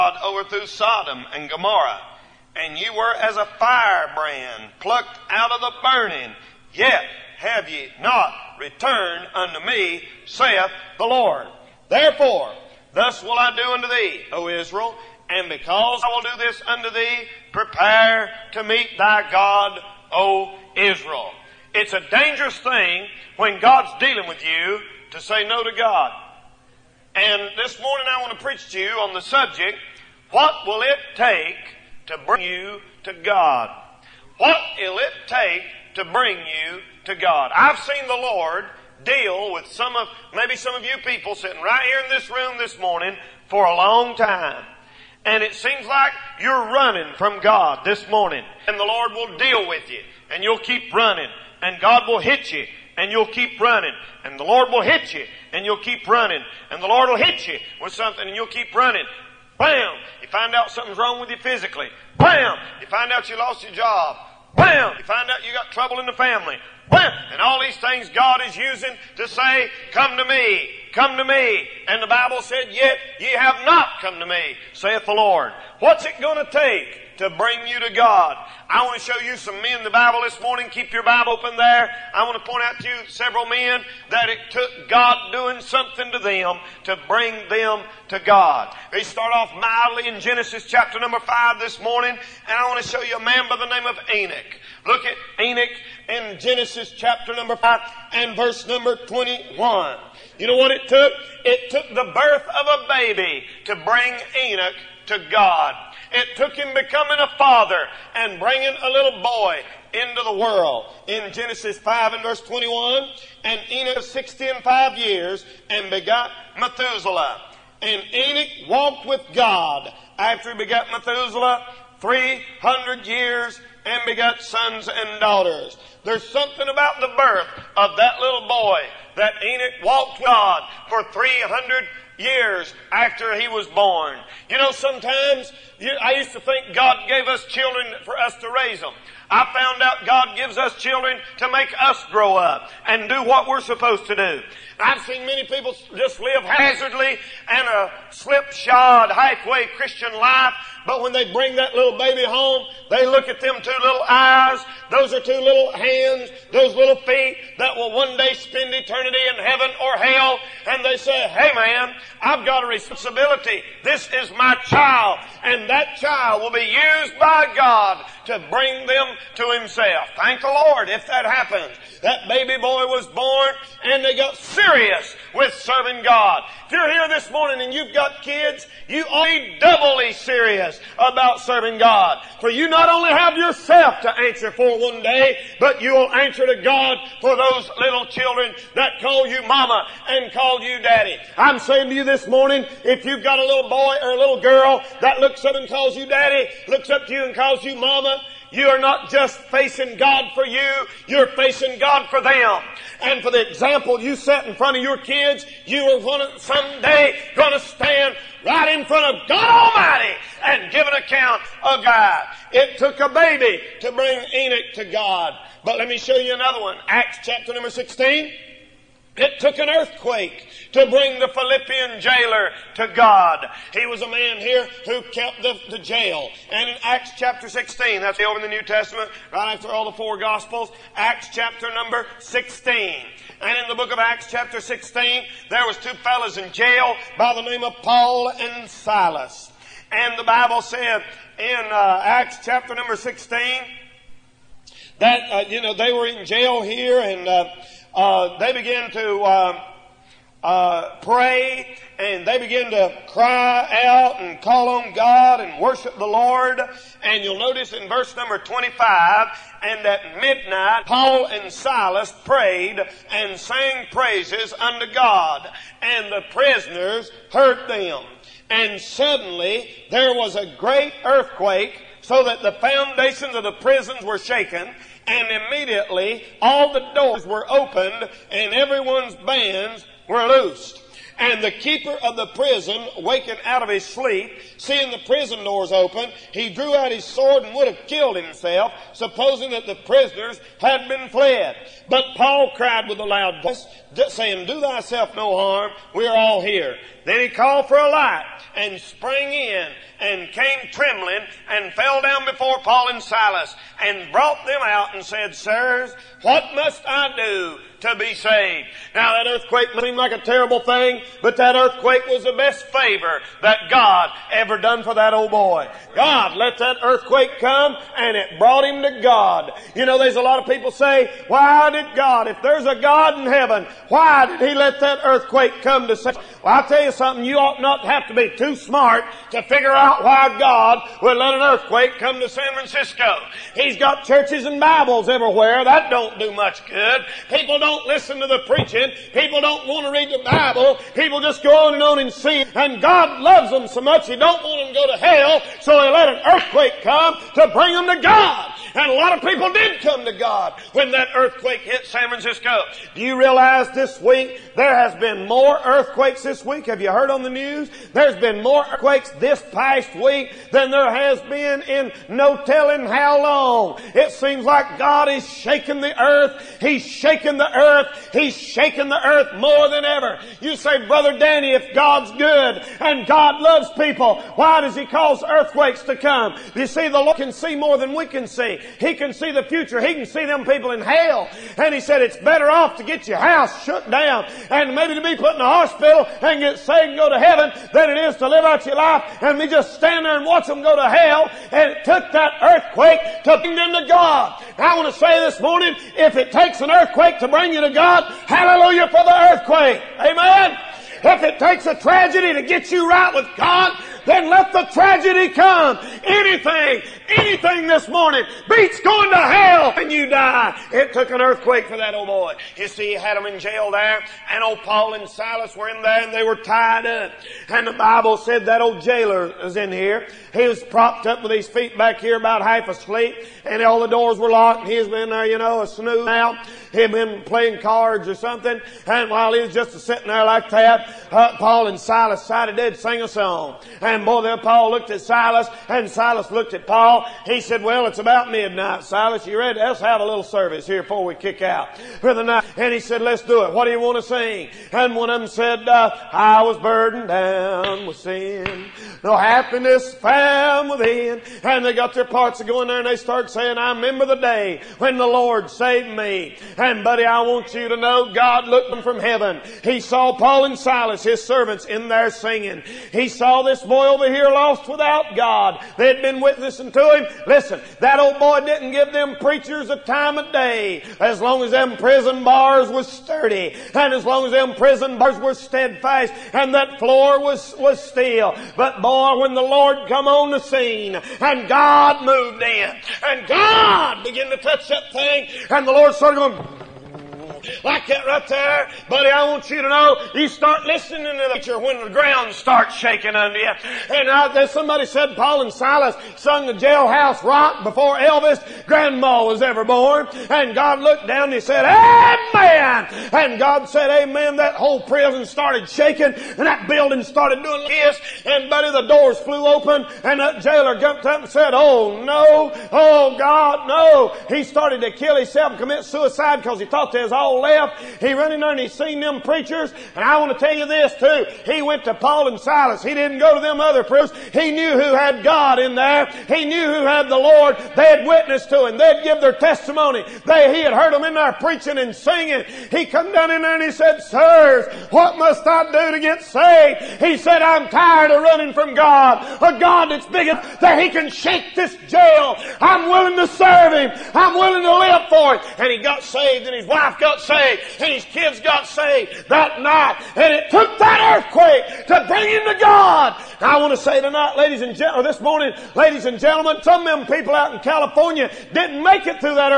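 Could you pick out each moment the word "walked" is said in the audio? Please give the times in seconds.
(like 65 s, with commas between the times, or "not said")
118 s, 129 s.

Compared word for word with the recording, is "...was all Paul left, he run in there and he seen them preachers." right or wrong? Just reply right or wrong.
right.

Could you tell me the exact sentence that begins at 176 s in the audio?
If you're here this morning and you've got kids, you ought to be doubly serious about serving God.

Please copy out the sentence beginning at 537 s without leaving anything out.
He said, I'm tired of running from God.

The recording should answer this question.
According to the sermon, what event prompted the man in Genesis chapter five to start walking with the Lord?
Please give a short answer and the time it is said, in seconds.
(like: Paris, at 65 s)
The birth of a baby, at 101 s.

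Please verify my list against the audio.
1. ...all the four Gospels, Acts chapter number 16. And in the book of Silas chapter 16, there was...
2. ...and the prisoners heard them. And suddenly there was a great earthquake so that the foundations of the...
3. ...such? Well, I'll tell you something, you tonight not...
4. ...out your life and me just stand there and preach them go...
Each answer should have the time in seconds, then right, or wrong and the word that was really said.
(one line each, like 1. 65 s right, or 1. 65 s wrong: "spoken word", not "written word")
1. 229 s wrong: "Acts", not "Silas"
2. 265 s right
3. 325 s wrong: "ought", not "tonight"
4. 388 s wrong: "watch", not "preach".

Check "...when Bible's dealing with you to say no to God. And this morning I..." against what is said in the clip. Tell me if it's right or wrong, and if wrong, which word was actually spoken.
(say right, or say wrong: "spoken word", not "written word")
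wrong: "God", not "Bible".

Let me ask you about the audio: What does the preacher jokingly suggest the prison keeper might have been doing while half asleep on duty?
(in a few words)
Playing cards.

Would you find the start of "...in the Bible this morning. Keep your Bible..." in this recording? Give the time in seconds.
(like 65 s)
79 s.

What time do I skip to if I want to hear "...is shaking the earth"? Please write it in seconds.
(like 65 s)
365 s.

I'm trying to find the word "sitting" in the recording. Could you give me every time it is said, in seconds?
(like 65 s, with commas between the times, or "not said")
41 s, 429 s.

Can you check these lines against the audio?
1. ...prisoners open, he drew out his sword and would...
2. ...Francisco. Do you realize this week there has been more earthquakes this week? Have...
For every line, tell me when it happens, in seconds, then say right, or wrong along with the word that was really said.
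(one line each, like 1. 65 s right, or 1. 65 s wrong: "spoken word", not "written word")
1. 285 s wrong: "doors", not "prisoners"
2. 352 s right.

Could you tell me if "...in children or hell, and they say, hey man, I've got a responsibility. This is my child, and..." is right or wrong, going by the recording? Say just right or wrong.
wrong.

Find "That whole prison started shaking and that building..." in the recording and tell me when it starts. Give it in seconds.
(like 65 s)
504 s.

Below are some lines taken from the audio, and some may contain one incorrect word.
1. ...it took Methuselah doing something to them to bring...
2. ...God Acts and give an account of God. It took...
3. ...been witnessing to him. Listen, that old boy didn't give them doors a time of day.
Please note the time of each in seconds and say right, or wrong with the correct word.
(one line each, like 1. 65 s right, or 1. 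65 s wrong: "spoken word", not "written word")
1. 84 s wrong: "God", not "Methuselah"
2. 209 s wrong: "Almighty", not "Acts"
3. 466 s wrong: "preachers", not "doors".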